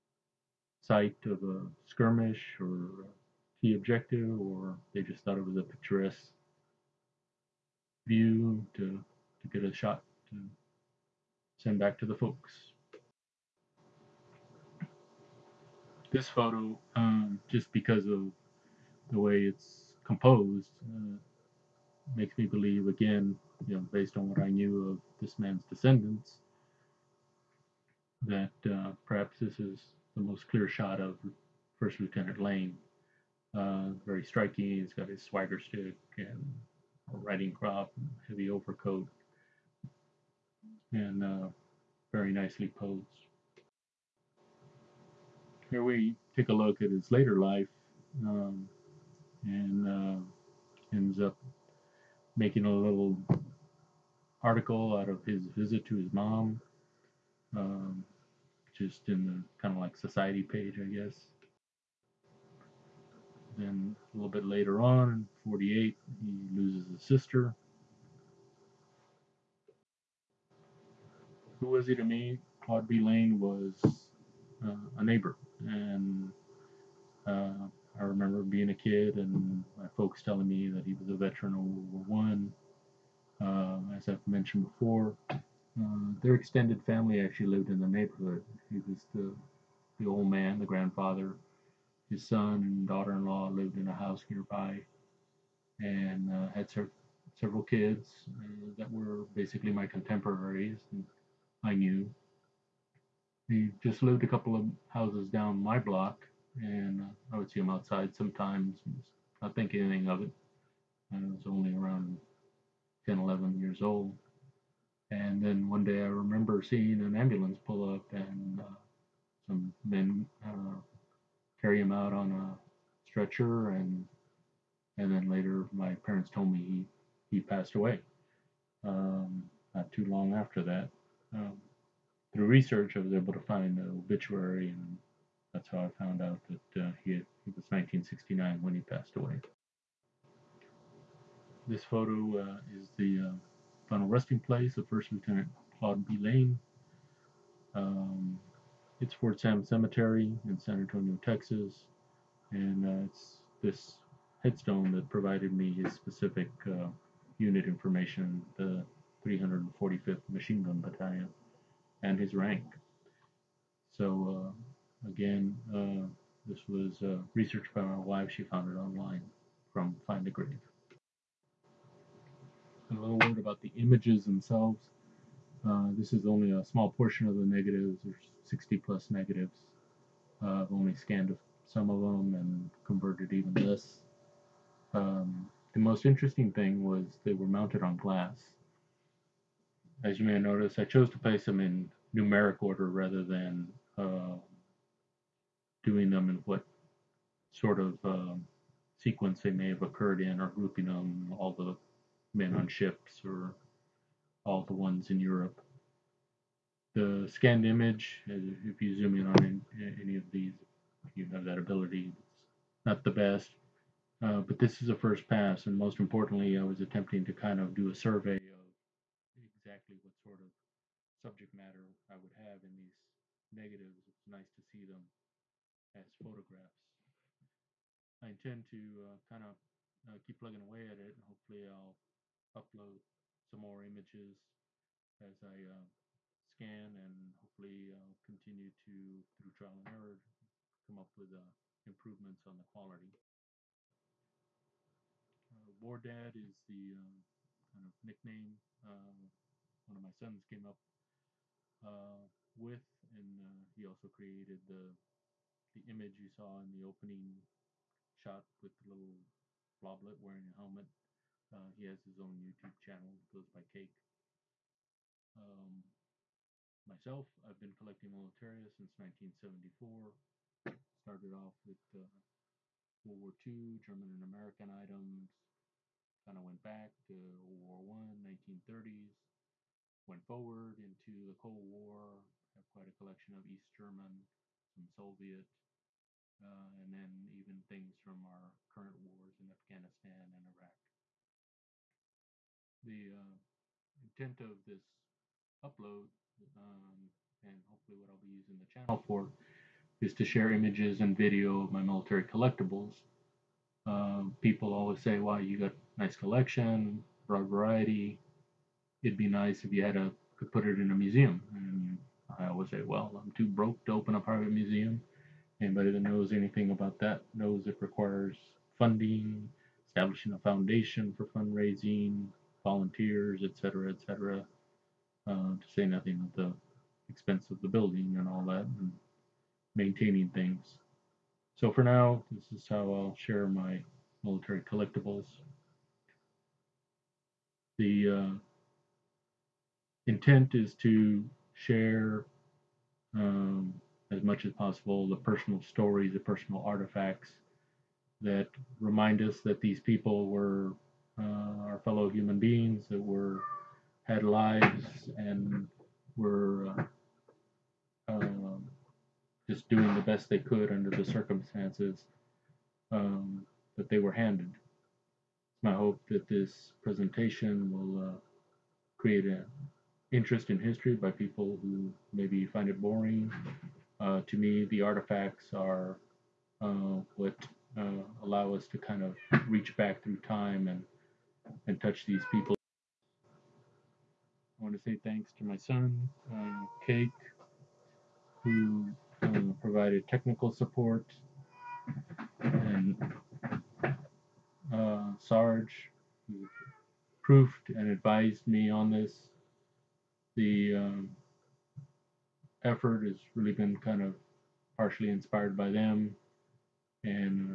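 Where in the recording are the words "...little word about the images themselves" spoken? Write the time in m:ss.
2:53.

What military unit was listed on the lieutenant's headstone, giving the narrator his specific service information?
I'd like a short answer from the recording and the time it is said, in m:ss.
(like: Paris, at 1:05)
345th Machine Gun Battalion, at 2:39.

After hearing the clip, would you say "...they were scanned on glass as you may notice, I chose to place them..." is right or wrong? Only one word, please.
wrong.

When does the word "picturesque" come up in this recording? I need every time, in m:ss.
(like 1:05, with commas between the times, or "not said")
0:05.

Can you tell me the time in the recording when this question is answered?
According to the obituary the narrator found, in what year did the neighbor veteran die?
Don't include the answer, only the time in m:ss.
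2:17.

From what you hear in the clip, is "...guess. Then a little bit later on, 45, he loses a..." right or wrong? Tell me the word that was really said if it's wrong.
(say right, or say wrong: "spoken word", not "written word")
wrong: "48", not "45".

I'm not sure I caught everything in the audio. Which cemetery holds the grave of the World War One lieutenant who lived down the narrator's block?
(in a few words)
Fort Sam Cemetery.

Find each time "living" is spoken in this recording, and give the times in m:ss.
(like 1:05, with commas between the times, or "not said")
not said.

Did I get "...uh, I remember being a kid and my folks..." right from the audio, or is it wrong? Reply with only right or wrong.
right.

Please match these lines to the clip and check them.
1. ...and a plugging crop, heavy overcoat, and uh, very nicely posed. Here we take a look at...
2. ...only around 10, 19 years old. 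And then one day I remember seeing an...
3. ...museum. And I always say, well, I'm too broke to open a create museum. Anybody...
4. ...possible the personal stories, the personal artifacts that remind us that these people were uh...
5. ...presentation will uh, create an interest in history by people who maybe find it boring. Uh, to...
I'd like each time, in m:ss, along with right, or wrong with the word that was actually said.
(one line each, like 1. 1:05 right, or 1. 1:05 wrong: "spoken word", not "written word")
1. 0:36 wrong: "riding", not "plugging"
2. 1:51 wrong: "11", not "19"
3. 5:10 wrong: "private", not "create"
4. 5:44 right
5. 6:06 right.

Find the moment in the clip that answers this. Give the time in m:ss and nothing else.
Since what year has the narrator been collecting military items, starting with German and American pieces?
4:28.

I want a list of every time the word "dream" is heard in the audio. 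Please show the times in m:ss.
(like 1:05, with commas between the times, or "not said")
not said.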